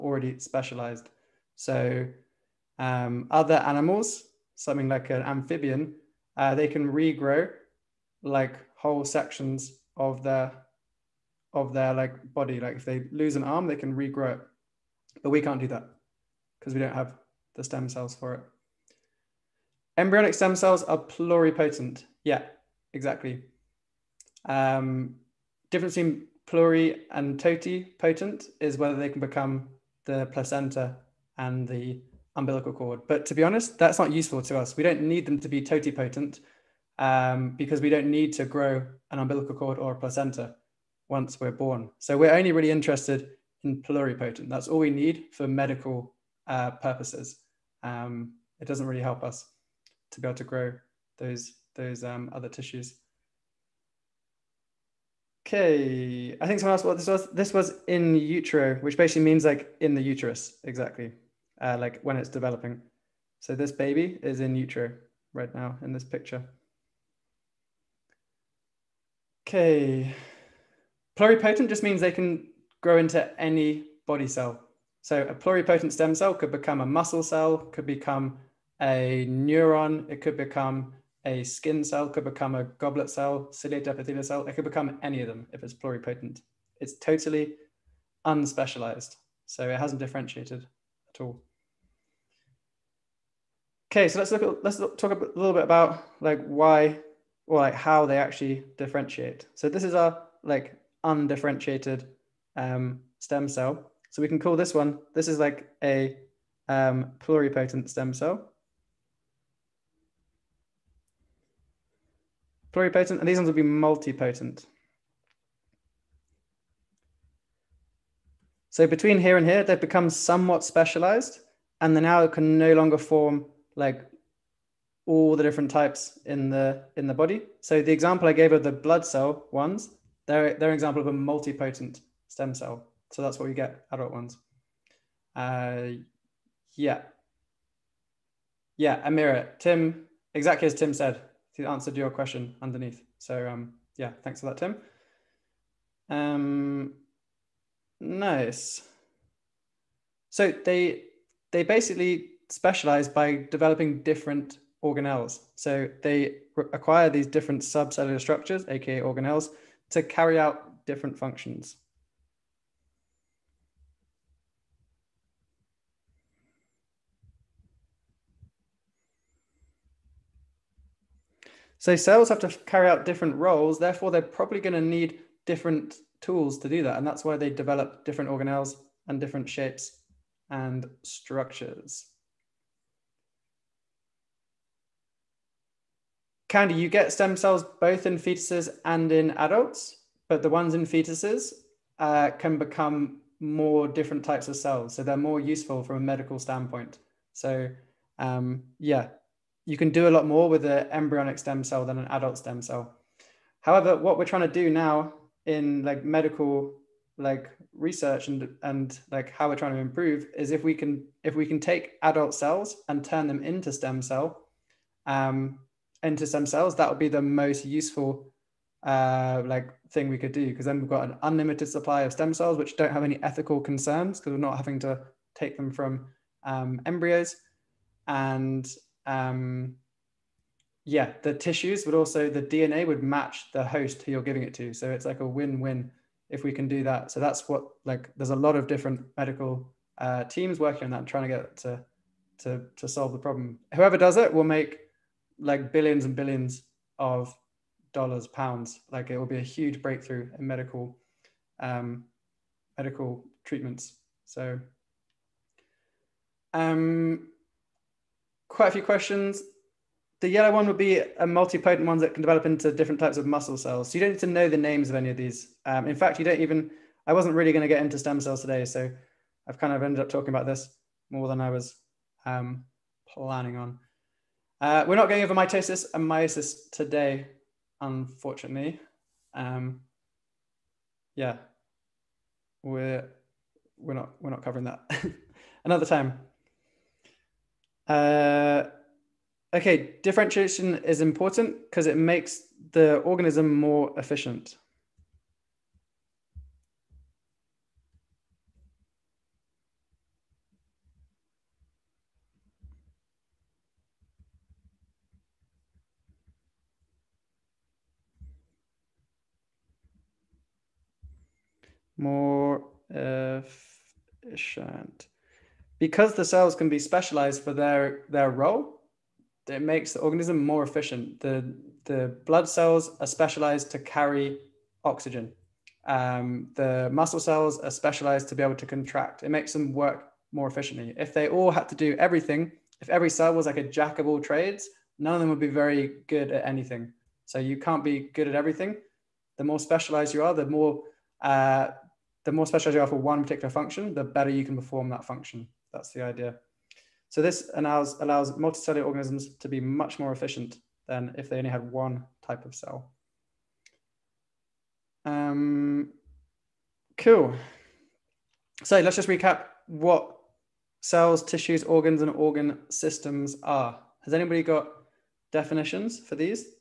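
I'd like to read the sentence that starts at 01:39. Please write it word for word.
So this is our like undifferentiated um, stem cell.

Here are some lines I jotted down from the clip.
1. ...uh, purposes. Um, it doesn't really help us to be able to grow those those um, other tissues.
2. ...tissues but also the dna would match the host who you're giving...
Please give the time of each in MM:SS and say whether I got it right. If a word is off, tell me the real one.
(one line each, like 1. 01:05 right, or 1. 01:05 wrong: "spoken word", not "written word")
1. 00:46 right
2. 03:51 right.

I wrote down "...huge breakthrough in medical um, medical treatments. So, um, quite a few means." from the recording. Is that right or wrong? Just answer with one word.
wrong.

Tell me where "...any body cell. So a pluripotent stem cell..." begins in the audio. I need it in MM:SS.
01:13.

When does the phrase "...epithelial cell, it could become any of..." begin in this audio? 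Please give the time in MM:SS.
01:23.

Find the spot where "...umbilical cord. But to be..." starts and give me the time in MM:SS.
00:32.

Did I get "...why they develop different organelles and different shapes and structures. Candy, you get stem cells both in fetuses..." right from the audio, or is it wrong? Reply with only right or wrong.
right.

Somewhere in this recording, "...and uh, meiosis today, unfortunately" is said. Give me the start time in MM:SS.
04:35.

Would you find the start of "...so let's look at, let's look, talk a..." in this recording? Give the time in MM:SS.
01:34.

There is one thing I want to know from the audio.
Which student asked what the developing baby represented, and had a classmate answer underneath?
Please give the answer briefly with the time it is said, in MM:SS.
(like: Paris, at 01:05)
Amira, at 02:19.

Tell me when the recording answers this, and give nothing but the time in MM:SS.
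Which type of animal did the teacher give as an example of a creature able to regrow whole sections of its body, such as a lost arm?
00:05.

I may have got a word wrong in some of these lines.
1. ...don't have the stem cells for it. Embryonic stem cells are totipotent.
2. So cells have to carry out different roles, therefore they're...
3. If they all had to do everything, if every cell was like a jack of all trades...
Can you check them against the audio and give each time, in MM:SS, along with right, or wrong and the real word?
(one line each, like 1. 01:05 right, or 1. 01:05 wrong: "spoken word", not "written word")
1. 00:16 wrong: "pluripotent", not "totipotent"
2. 02:51 right
3. 05:30 right.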